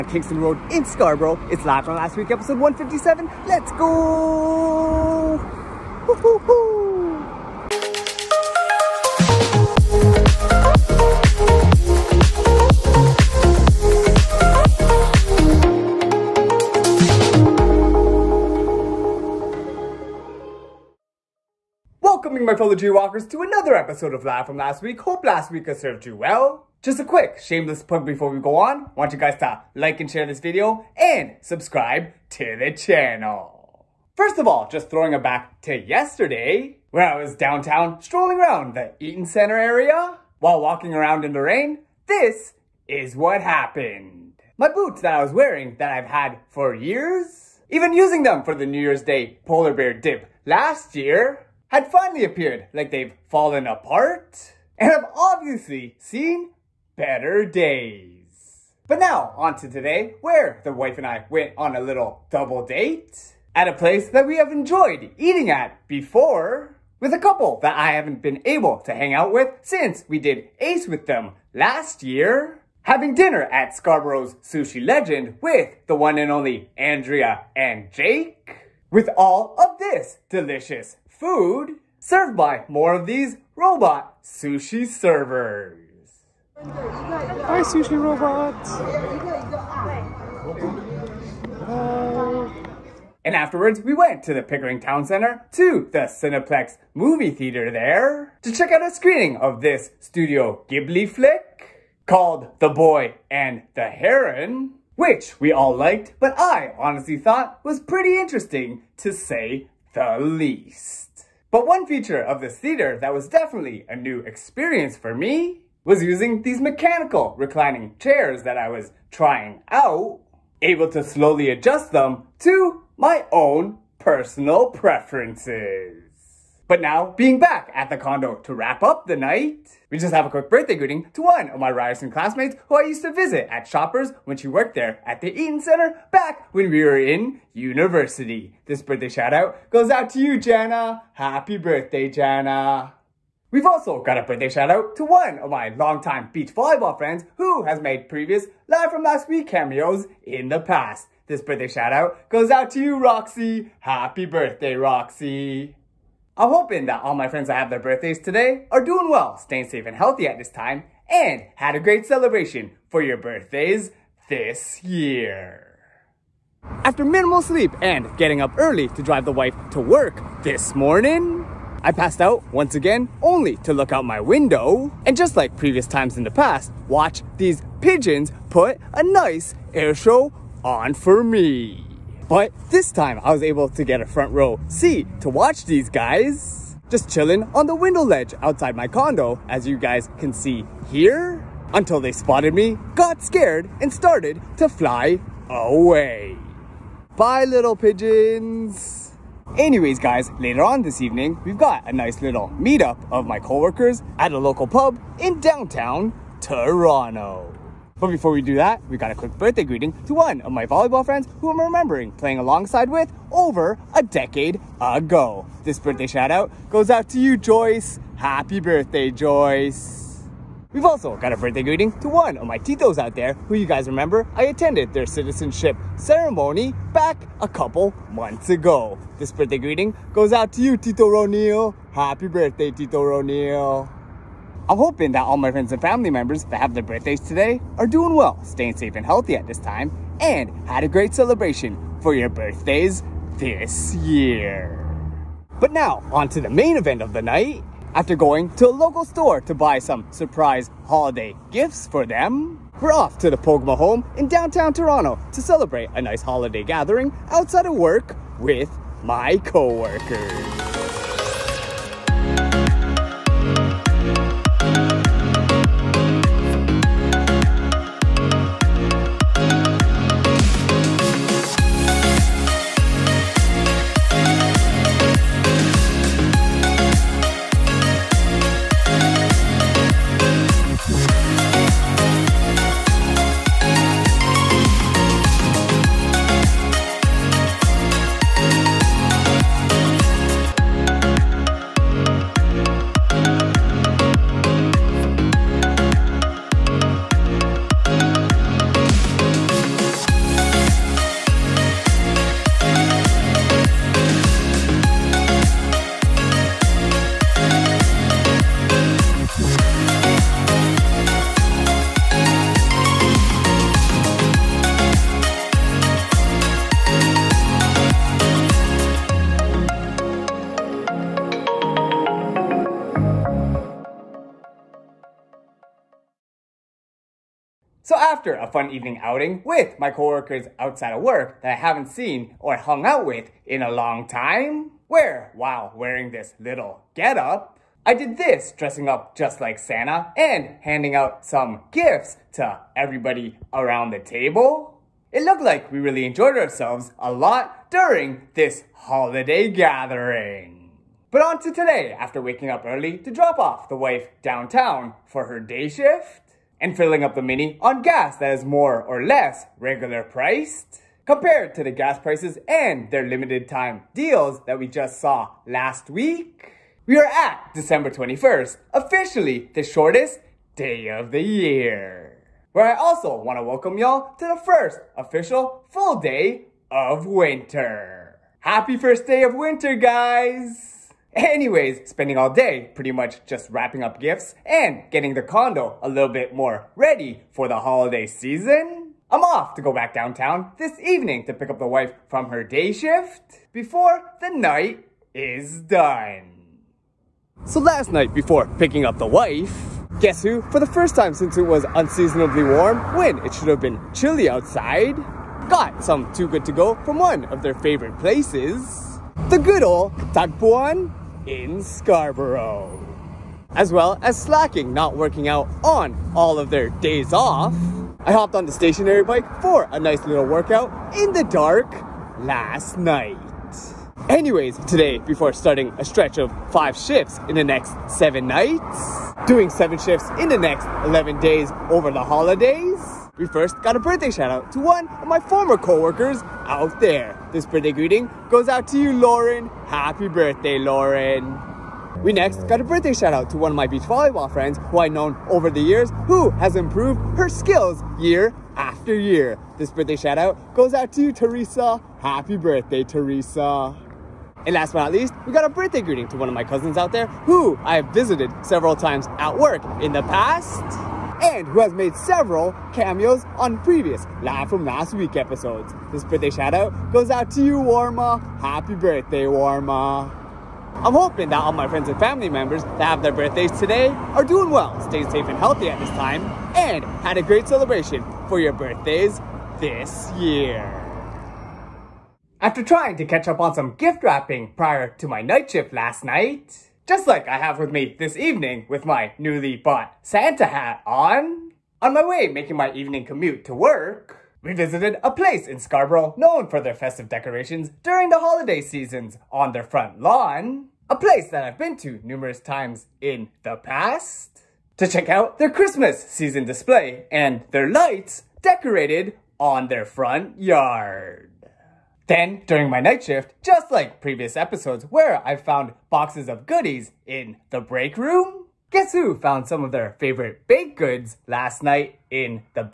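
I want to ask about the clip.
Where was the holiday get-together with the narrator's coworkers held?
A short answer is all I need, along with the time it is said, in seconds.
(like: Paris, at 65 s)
Pogma home, at 253 s.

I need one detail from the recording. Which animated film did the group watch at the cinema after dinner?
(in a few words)
The Boy and the Heron.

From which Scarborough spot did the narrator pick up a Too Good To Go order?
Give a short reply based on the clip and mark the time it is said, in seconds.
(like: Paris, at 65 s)
Tagpuan, at 410 s.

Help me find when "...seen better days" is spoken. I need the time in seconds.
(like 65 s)
55 s.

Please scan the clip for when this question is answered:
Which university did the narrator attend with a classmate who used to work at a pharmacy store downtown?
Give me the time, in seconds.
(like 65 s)
131 s.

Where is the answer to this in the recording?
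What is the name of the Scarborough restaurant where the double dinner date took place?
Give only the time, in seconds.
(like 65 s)
74 s.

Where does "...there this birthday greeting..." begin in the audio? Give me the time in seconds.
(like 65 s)
436 s.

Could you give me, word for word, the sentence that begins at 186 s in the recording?
Just chilling on the window ledge outside my condo, as you guys can see here.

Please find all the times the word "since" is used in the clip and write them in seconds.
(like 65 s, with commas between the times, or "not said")
69 s, 401 s.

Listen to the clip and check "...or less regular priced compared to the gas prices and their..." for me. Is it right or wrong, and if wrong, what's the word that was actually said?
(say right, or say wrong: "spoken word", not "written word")
right.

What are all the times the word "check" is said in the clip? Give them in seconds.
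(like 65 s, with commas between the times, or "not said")
98 s, 504 s.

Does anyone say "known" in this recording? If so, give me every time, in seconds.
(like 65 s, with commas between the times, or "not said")
444 s, 496 s.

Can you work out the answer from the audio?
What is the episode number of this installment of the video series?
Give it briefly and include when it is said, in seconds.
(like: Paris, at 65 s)
157, at 2 s.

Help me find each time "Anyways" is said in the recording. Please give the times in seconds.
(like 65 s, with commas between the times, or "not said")
199 s, 381 s, 424 s.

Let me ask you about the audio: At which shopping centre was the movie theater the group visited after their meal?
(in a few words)
Pickering Town Center.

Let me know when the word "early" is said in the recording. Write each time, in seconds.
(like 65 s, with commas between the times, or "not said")
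168 s, 352 s.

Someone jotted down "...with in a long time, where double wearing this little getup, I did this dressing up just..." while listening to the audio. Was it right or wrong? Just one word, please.
wrong.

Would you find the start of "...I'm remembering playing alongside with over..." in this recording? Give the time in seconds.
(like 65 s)
211 s.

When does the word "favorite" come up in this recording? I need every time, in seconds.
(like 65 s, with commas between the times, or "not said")
407 s, 519 s.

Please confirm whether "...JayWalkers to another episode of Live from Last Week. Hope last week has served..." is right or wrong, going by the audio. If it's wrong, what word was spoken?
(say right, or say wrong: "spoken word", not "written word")
right.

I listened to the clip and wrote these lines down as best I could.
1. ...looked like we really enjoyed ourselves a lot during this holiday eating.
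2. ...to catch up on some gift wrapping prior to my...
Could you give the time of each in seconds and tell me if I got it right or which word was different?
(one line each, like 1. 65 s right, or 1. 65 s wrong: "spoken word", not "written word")
1. 345 s wrong: "gathering", not "eating"
2. 482 s right.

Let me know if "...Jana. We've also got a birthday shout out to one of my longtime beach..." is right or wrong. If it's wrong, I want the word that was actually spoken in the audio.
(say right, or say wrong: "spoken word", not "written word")
right.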